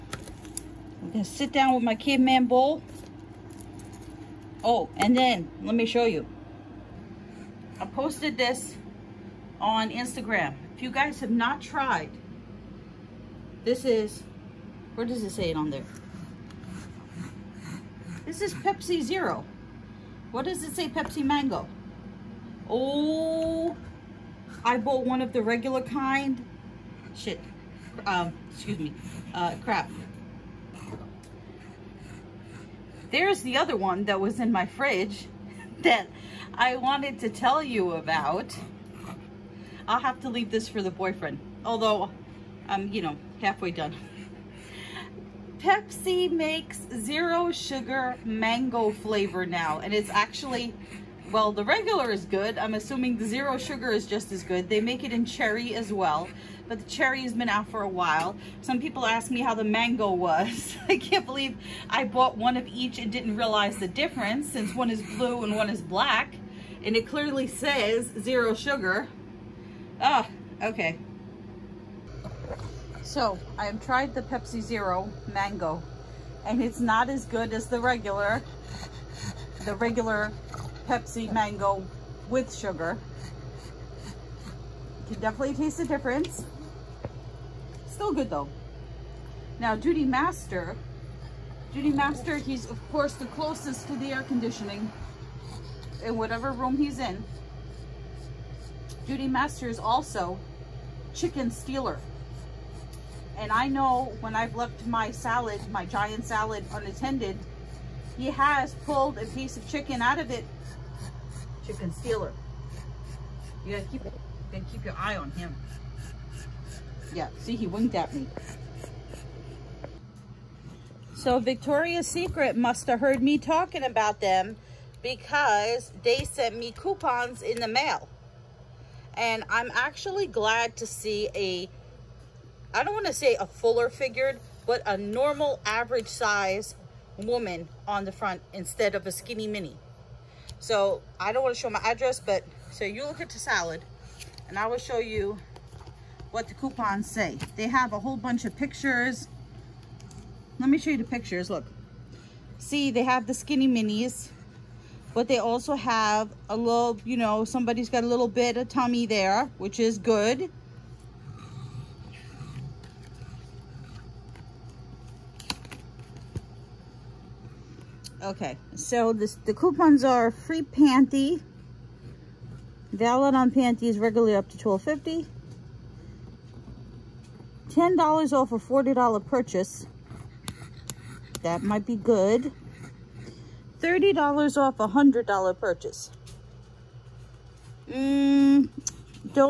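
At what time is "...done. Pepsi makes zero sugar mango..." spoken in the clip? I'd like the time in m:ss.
0:43.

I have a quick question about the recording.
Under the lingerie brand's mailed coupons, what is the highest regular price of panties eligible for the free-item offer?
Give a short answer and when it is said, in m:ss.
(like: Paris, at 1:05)
$12.50, at 2:54.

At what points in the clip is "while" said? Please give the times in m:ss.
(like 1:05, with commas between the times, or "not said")
0:57.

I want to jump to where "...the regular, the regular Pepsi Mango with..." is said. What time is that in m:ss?
1:17.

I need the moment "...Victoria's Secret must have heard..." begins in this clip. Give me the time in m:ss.
2:01.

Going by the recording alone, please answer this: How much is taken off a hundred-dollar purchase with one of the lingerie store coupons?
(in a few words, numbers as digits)
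$30.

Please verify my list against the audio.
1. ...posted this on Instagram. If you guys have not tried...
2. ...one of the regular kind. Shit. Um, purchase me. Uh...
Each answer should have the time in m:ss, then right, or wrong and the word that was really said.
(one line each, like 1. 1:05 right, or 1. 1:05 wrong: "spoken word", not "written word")
1. 0:07 right
2. 0:25 wrong: "excuse", not "purchase".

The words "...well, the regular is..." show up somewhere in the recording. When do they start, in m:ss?
0:51.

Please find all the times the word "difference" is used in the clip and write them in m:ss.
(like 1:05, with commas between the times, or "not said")
1:03, 1:25.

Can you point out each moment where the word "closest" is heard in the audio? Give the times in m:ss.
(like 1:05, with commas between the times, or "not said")
1:33.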